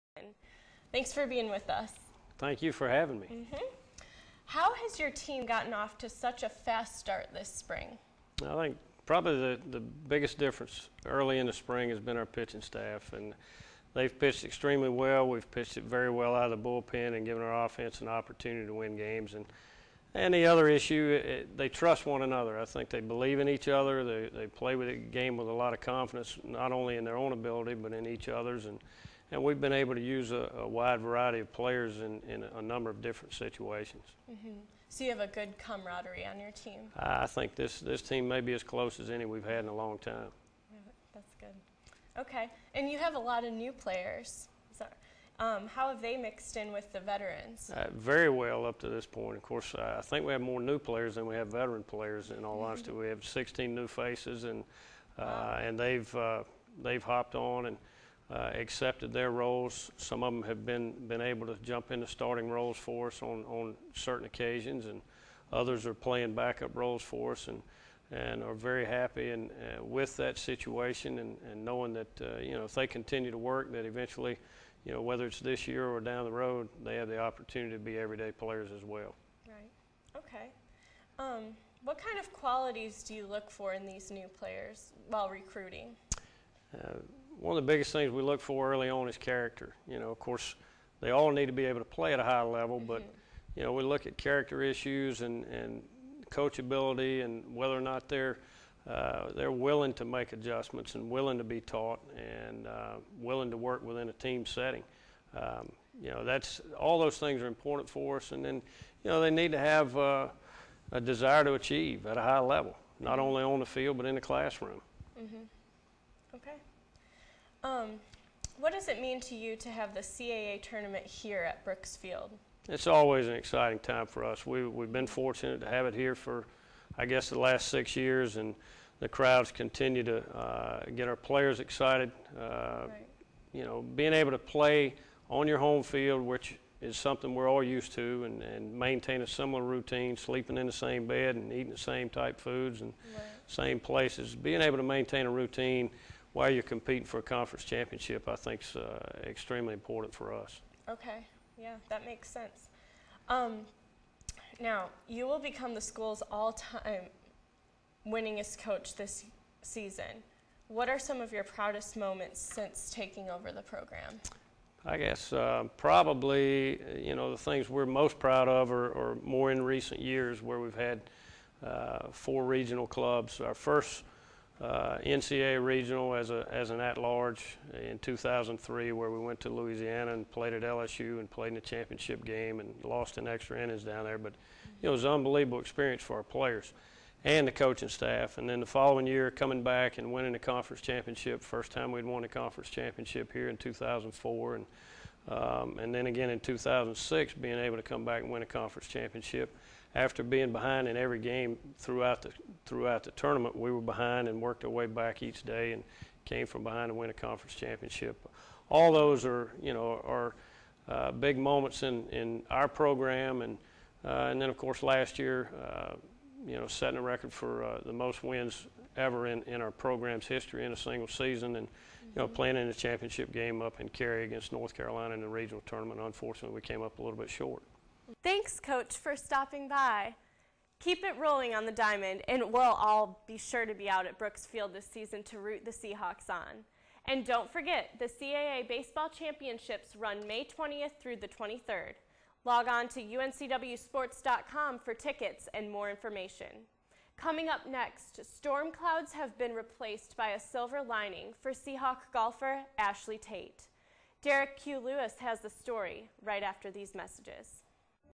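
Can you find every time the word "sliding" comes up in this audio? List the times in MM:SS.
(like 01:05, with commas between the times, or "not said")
not said.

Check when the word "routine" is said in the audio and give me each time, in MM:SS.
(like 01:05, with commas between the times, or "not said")
02:19, 02:25.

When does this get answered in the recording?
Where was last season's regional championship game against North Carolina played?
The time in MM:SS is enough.
03:43.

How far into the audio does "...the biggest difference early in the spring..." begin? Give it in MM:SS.
00:09.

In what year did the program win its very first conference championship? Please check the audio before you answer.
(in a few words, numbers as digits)
2004.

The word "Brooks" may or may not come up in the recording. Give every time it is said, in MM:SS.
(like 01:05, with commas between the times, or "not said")
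02:01, 03:54.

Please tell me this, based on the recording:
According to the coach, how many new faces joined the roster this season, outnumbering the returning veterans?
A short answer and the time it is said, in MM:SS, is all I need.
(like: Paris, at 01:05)
16, at 00:53.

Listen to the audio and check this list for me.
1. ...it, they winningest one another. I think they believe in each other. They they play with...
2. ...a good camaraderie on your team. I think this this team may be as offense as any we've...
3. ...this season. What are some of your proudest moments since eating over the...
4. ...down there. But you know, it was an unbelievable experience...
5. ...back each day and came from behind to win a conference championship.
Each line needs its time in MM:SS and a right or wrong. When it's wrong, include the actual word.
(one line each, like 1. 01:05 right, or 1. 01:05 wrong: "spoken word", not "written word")
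1. 00:21 wrong: "trust", not "winningest"
2. 00:35 wrong: "close", not "offense"
3. 02:38 wrong: "taking", not "eating"
4. 03:03 right
5. 03:24 right.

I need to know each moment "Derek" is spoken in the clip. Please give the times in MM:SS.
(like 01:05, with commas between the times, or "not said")
04:14.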